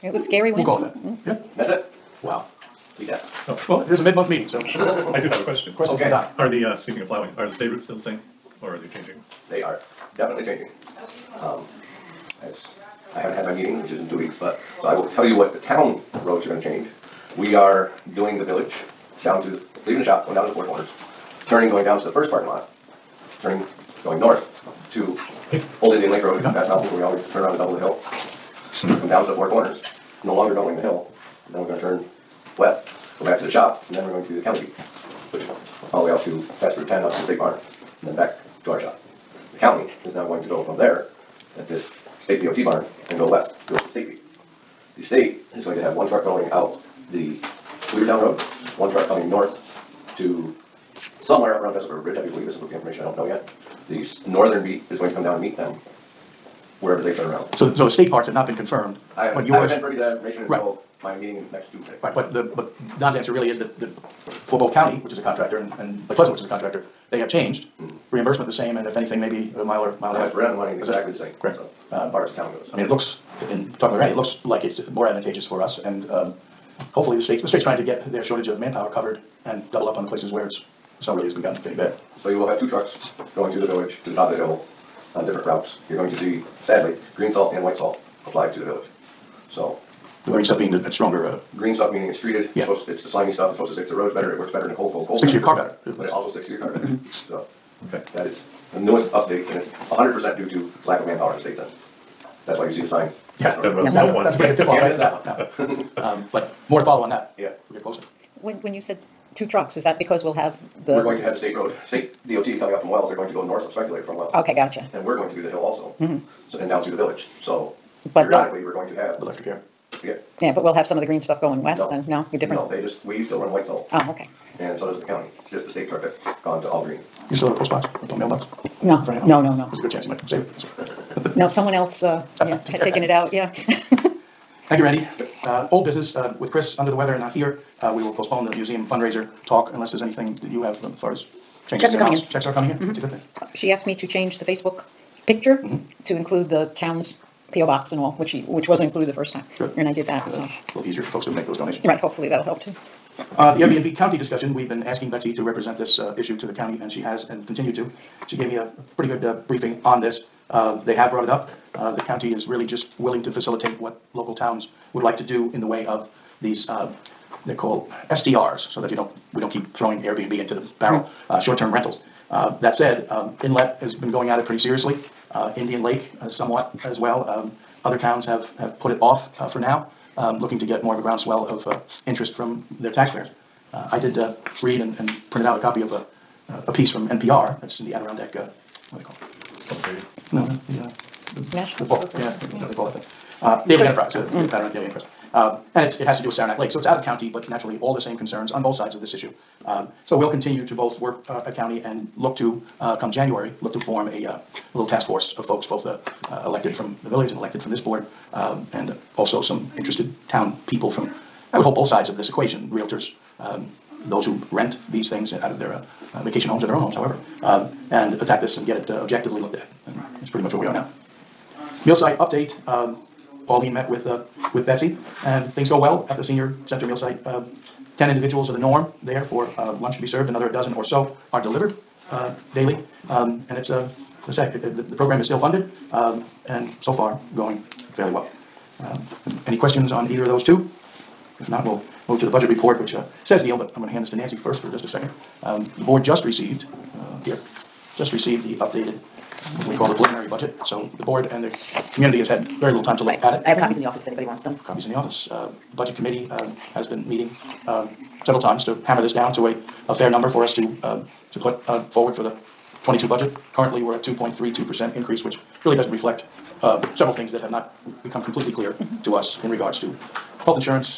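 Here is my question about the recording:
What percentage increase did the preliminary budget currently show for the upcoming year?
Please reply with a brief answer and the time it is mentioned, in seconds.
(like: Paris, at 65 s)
2.32%, at 264 s.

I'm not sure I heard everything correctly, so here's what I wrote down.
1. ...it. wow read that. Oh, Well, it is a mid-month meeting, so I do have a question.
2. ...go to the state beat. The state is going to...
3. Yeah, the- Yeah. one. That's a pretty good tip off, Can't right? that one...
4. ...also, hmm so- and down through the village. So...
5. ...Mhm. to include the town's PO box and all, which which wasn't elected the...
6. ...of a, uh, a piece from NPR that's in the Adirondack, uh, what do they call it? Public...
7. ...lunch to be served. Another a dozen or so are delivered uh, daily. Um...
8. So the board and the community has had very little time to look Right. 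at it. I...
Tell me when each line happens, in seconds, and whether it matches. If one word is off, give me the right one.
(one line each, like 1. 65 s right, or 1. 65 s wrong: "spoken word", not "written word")
1. 1 s right
2. 43 s right
3. 103 s right
4. 115 s right
5. 145 s wrong: "included", not "elected"
6. 185 s right
7. 229 s right
8. 250 s right.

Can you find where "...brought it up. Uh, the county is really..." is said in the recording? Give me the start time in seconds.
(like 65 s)
161 s.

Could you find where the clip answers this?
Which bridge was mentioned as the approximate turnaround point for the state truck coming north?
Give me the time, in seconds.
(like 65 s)
51 s.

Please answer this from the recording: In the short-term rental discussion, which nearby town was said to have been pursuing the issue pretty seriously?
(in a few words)
Inlet.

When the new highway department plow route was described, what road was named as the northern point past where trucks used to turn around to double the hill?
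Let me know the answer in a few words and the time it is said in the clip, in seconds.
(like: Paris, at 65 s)
Old Indian Lake Road, at 25 s.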